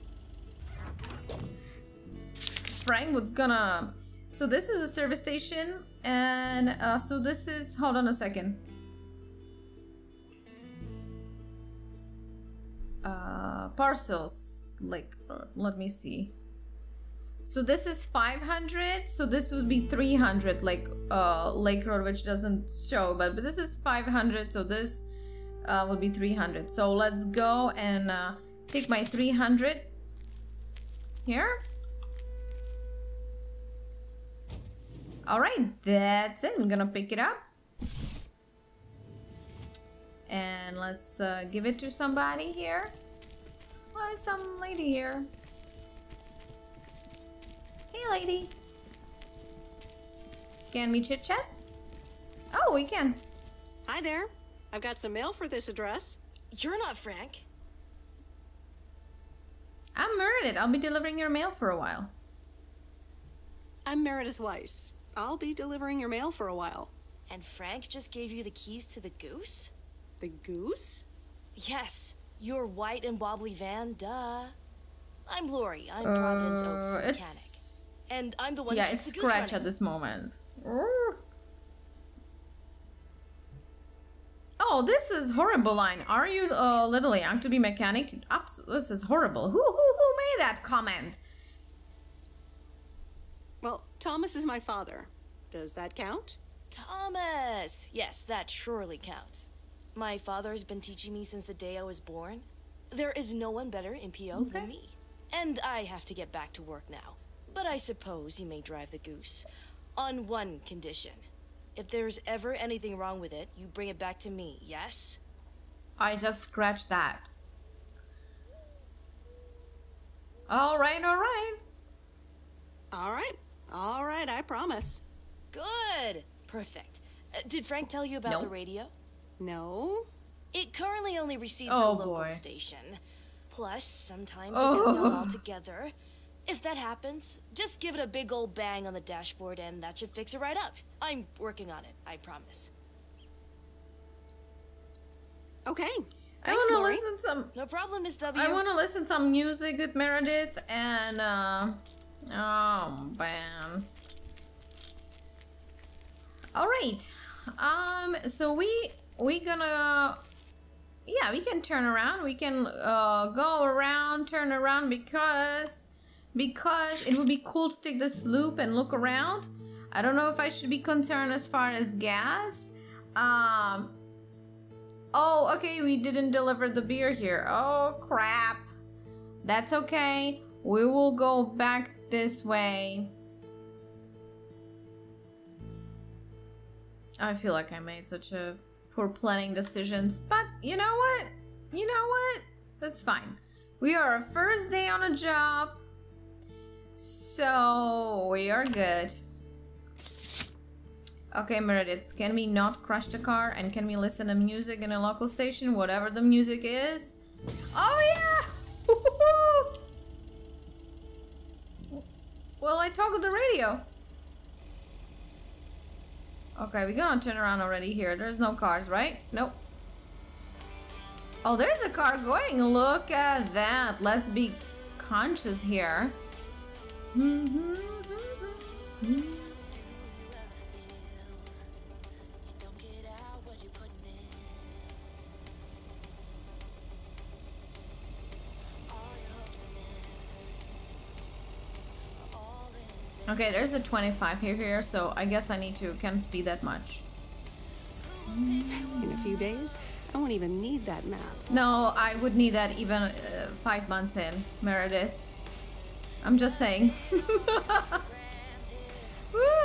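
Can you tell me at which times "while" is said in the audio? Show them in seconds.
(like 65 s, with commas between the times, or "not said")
61 s, 66 s.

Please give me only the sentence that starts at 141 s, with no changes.
I'm working on it, I promise.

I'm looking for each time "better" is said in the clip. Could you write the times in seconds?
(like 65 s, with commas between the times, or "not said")
103 s.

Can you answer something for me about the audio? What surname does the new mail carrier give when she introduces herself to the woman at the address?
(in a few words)
Weiss.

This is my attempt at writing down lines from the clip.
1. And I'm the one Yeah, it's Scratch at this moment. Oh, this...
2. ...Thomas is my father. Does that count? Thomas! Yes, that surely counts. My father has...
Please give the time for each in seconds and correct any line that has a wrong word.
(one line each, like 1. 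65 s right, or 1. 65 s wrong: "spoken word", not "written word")
1. 78 s right
2. 93 s right.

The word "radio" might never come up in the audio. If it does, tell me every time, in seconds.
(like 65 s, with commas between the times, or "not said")
128 s, 213 s.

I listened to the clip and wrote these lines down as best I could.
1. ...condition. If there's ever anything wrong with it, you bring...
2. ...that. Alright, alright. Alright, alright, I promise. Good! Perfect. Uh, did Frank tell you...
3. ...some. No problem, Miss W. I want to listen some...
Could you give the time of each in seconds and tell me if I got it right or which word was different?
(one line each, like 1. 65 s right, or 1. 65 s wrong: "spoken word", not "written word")
1. 110 s right
2. 116 s right
3. 147 s right.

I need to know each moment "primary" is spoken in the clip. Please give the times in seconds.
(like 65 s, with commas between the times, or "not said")
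not said.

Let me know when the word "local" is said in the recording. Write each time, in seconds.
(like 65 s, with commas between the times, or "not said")
131 s, 205 s.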